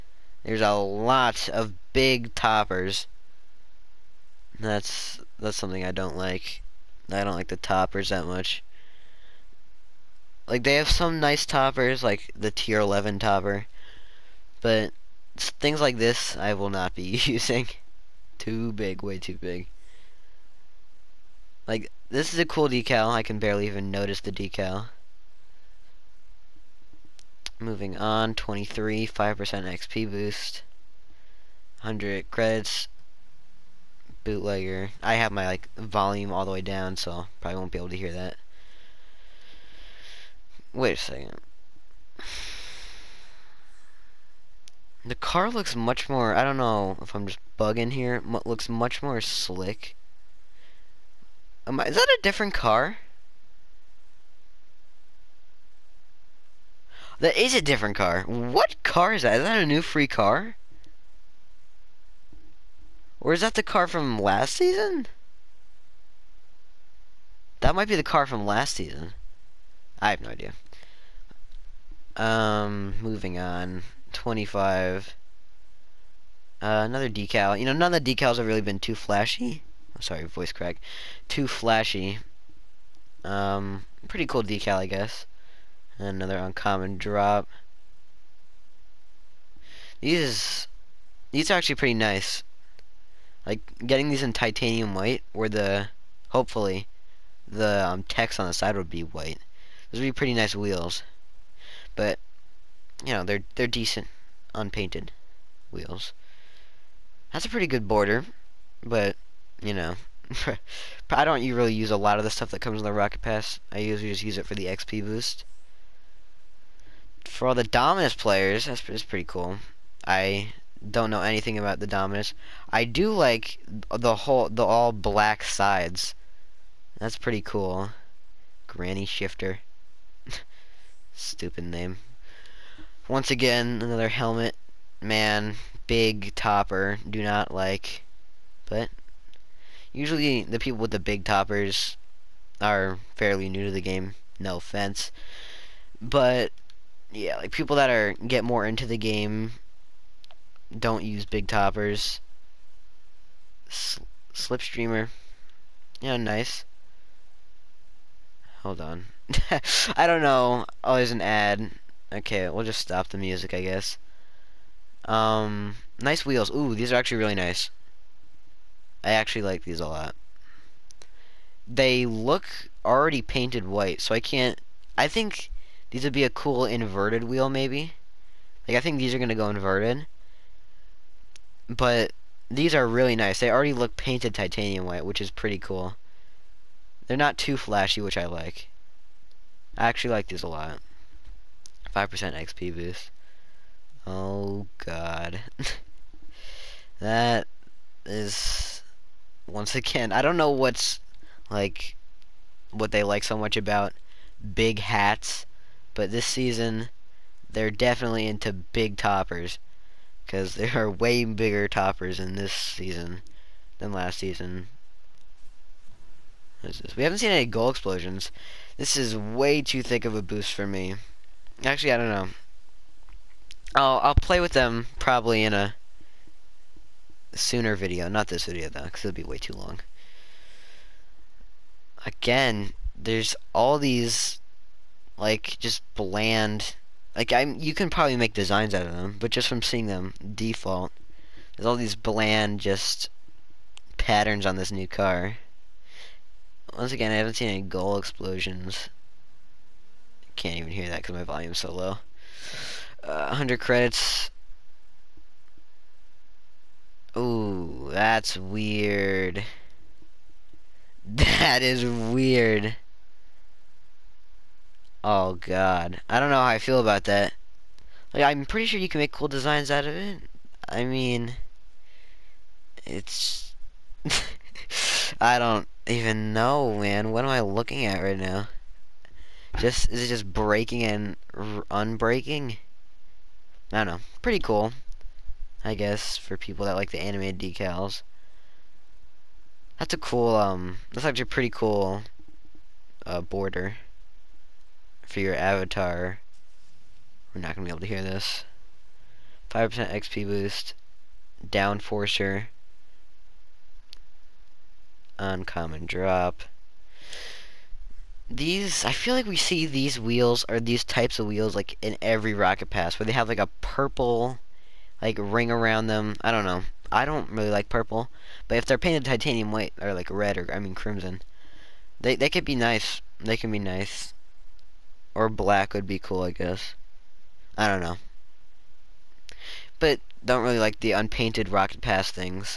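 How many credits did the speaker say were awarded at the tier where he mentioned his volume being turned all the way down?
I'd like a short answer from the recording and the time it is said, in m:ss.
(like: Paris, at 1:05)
100, at 0:31.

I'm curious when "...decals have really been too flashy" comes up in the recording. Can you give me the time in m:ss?
1:18.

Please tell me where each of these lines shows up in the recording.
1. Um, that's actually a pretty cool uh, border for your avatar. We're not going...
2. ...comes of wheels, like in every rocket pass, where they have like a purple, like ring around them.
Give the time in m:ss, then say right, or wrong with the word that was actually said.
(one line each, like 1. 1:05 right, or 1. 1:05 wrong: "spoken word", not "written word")
1. 4:50 right
2. 5:10 wrong: "types", not "comes".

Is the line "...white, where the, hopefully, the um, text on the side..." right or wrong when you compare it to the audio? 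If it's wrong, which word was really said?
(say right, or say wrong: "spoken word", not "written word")
right.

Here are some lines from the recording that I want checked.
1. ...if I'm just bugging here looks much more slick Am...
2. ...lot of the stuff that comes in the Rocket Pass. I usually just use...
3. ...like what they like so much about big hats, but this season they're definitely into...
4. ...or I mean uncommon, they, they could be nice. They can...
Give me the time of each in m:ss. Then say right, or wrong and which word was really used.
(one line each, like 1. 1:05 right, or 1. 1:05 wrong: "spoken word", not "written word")
1. 0:47 right
2. 1:51 right
3. 3:21 right
4. 5:20 wrong: "crimson", not "uncommon".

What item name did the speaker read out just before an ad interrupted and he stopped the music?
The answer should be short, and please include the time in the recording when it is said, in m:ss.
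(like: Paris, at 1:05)
Slipstreamer, at 2:34.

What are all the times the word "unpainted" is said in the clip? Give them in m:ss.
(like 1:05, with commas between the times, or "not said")
1:44, 5:30.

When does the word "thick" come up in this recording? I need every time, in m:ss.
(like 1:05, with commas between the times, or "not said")
3:39.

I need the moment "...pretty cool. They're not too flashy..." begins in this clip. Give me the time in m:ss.
3:05.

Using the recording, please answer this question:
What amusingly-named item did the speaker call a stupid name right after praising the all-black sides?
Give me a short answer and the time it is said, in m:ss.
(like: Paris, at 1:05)
Granny Shifter, at 2:08.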